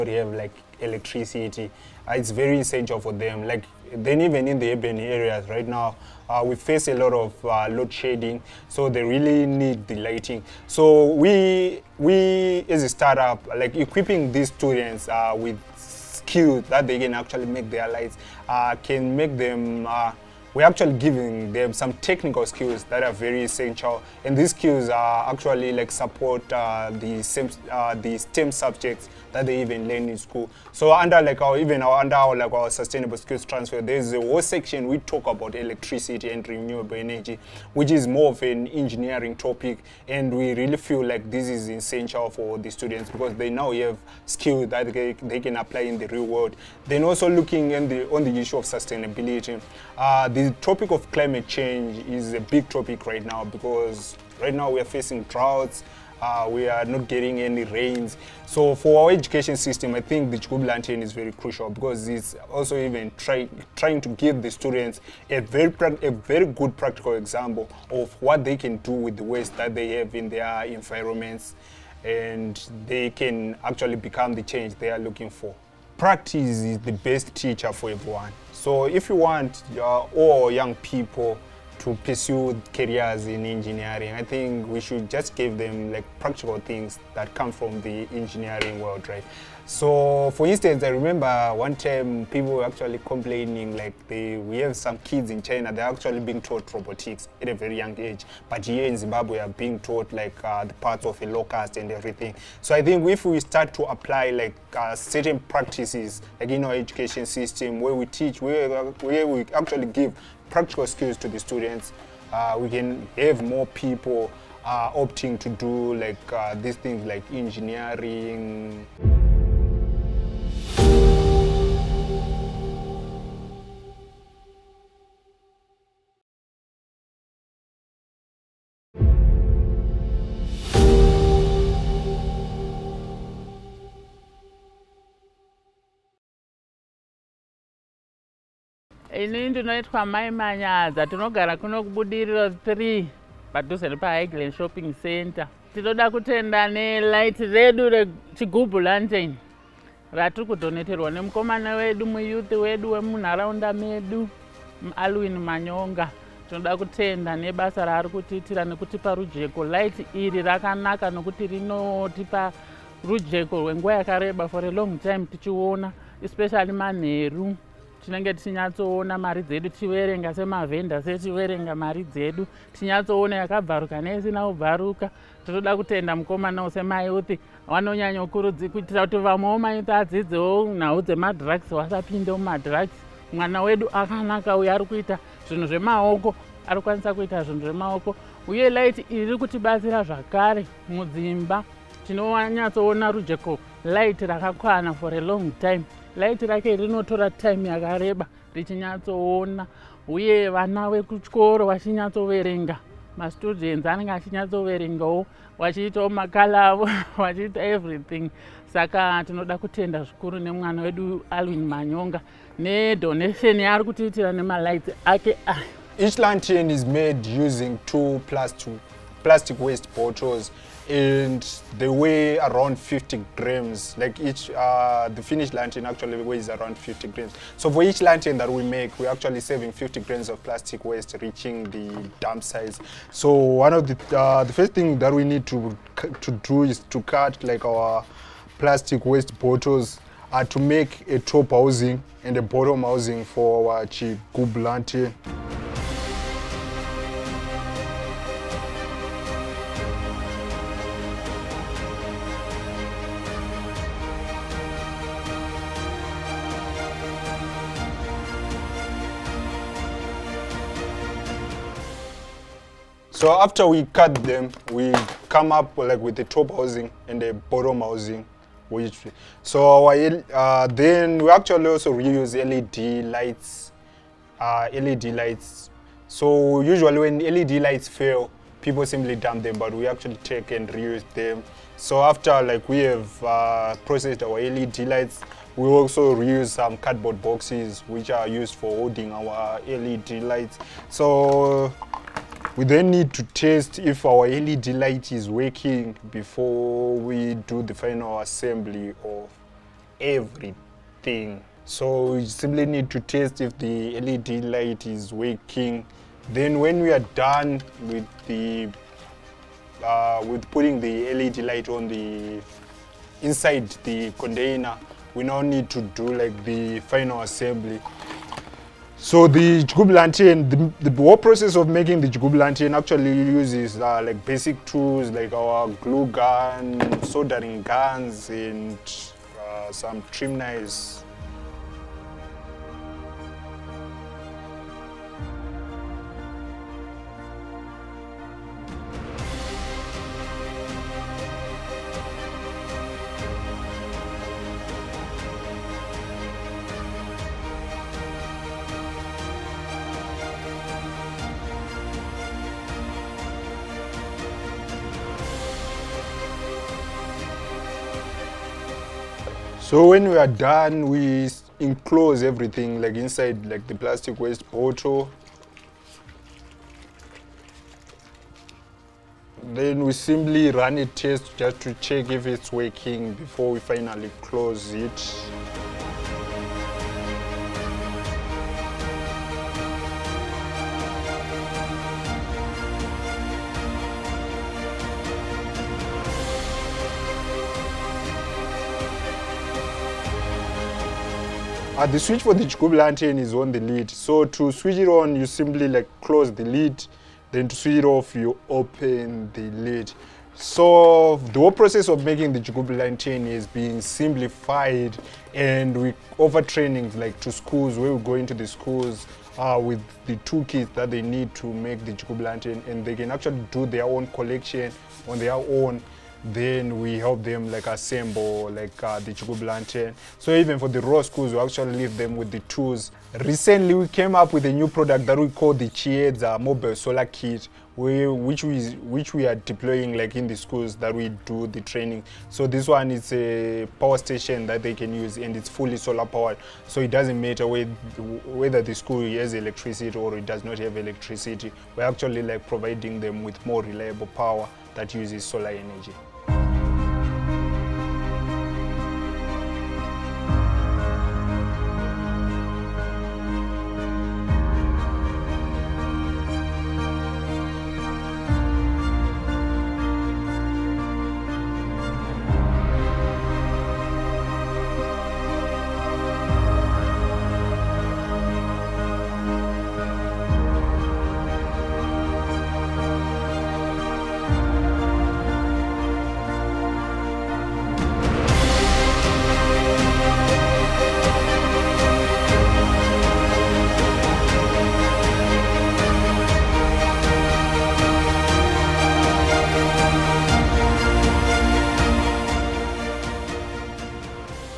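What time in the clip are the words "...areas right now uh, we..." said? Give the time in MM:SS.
00:04.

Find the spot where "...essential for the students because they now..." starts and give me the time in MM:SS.
00:41.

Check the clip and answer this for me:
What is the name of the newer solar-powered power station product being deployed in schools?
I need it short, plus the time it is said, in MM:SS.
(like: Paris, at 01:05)
Chiedza Mobile Solar Kit, at 07:05.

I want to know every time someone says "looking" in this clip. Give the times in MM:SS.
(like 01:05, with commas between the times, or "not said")
00:47, 01:14.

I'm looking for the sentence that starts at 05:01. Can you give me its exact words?
So we simply need to test if the LED light is working.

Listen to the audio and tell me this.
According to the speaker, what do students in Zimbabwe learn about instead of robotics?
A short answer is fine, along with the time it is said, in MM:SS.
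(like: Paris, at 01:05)
the parts of a locust, at 01:40.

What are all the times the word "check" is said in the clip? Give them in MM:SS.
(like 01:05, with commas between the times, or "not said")
06:11.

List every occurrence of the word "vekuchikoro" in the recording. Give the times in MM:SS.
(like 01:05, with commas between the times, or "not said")
03:20.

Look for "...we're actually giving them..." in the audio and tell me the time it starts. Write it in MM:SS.
00:20.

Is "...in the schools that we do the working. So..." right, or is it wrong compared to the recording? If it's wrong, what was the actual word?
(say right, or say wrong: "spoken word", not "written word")
wrong: "training", not "working".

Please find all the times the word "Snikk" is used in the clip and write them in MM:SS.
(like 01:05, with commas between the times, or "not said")
not said.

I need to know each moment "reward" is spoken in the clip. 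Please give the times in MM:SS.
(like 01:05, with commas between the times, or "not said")
not said.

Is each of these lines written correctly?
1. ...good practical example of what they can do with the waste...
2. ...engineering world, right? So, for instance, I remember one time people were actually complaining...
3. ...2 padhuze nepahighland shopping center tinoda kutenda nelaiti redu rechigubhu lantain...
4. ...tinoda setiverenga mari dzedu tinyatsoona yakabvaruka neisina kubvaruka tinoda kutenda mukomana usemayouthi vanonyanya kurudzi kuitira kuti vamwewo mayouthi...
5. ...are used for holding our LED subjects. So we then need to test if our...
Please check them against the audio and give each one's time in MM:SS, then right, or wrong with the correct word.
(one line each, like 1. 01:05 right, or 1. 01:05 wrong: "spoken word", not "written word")
1. 01:06 right
2. 01:28 right
3. 02:22 wrong: "3", not "2"
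4. 02:50 wrong: "semavhenda", not "tinoda"
5. 04:48 wrong: "lights", not "subjects".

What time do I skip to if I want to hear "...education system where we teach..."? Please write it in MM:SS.
01:46.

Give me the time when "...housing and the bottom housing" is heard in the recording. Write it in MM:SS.
04:26.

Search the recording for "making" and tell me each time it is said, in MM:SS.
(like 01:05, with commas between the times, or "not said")
05:21, 06:42.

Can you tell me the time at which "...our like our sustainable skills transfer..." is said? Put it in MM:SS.
00:32.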